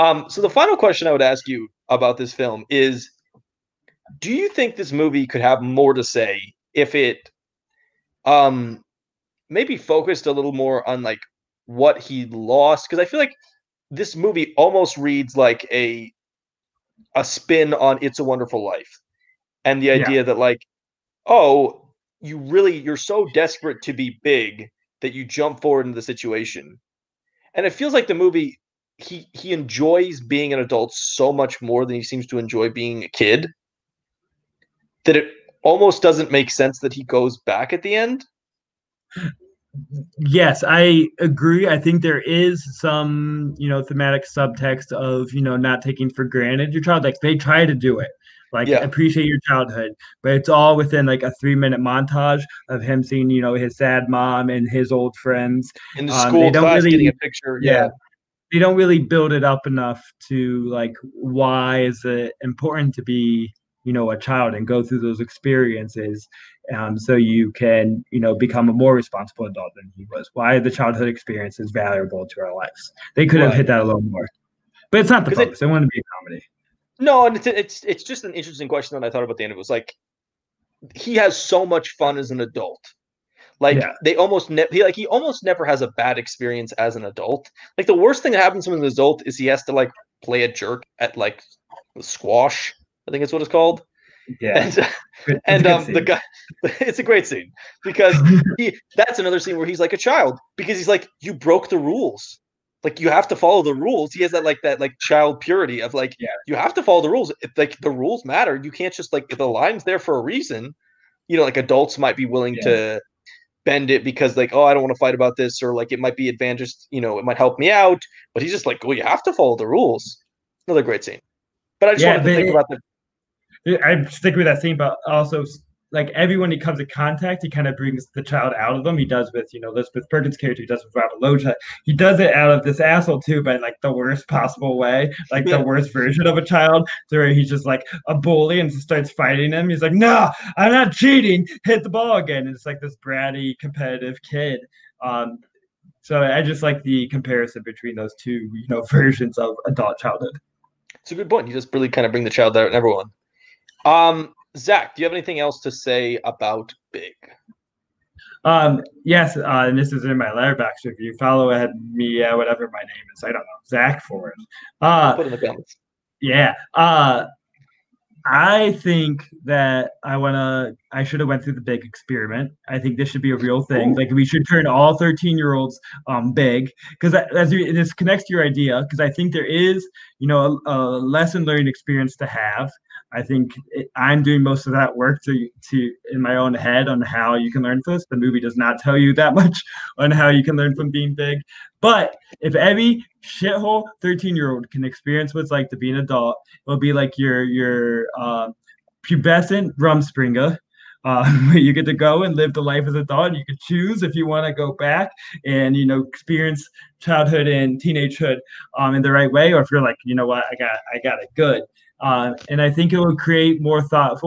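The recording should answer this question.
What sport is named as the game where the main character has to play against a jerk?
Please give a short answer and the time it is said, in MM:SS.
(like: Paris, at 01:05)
Squash, at 01:31.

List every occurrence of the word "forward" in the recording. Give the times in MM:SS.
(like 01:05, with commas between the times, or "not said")
00:25.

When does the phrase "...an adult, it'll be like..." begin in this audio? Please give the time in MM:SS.
03:15.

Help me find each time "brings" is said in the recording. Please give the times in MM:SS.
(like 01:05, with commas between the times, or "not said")
02:07, 02:32.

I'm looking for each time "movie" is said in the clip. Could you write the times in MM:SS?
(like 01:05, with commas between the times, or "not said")
00:04, 00:14, 00:28, 03:08.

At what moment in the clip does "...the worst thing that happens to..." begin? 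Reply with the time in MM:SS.
01:27.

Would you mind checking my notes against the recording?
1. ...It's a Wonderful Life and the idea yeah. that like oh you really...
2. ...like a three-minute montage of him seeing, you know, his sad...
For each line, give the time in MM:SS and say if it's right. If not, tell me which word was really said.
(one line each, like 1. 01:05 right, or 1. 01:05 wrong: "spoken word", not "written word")
1. 00:18 right
2. 00:51 right.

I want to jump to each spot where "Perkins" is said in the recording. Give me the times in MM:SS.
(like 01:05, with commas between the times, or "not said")
02:10.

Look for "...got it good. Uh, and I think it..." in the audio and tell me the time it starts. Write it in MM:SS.
03:31.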